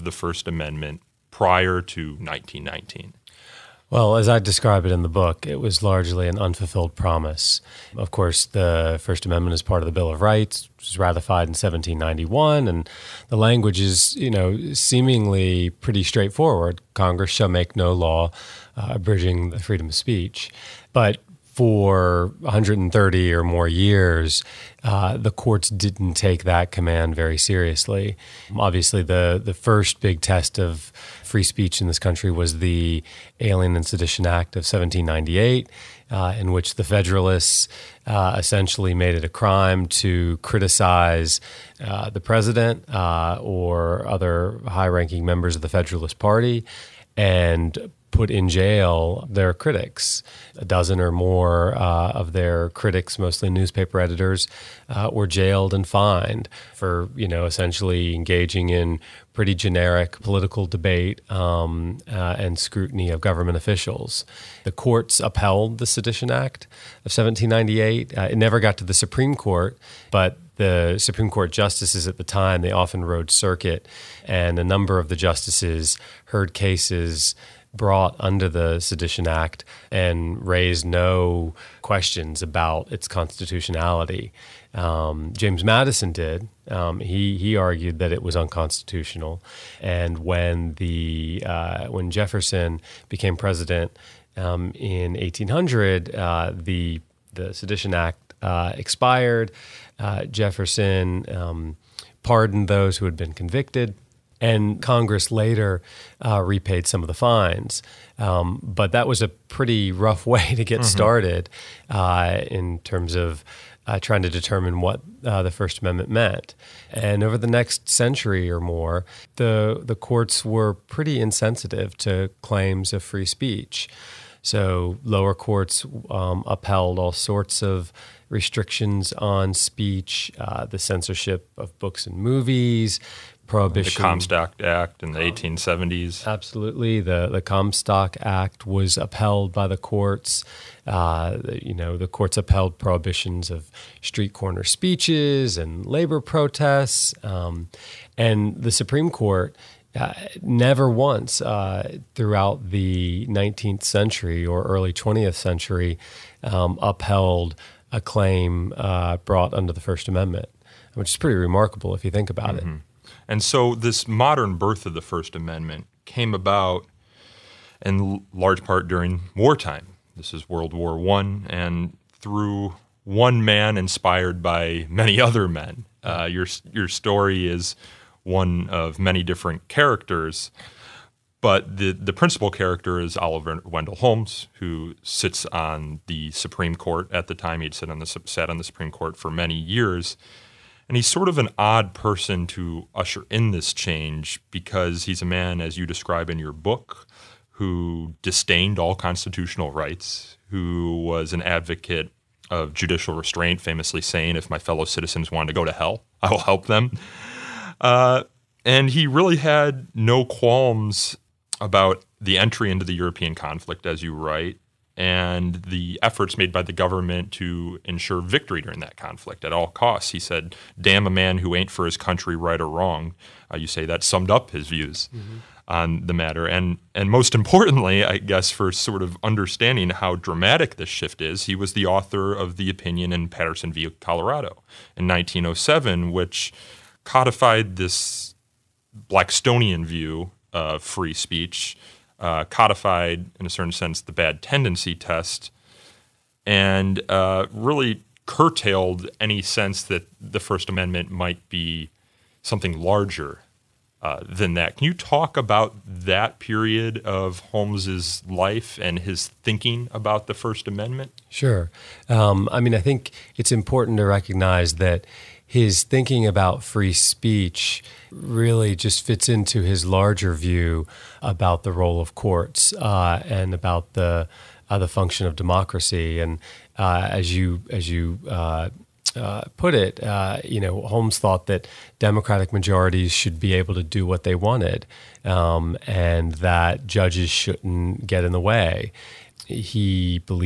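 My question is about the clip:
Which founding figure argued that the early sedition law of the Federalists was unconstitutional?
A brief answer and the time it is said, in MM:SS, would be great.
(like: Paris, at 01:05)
James Madison, at 01:25.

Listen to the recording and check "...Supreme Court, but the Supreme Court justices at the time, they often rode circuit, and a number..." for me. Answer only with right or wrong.
right.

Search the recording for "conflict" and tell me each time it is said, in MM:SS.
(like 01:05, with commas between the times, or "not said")
03:33, 03:38.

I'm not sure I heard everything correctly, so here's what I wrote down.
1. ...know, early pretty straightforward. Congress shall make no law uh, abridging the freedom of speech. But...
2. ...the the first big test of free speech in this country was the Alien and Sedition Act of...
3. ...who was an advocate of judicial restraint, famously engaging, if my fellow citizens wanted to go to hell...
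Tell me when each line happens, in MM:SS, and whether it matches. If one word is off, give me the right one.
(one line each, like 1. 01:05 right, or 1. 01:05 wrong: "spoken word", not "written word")
1. 00:14 wrong: "seemingly", not "early"
2. 00:29 right
3. 03:20 wrong: "saying", not "engaging".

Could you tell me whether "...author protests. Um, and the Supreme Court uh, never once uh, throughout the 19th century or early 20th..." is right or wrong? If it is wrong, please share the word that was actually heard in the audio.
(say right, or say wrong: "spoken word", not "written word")
wrong: "labor", not "author".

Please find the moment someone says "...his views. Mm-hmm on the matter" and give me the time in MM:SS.
03:44.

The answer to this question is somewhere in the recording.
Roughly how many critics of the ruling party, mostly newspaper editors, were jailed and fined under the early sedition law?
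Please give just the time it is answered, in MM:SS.
00:50.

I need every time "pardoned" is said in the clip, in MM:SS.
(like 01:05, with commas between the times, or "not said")
01:42.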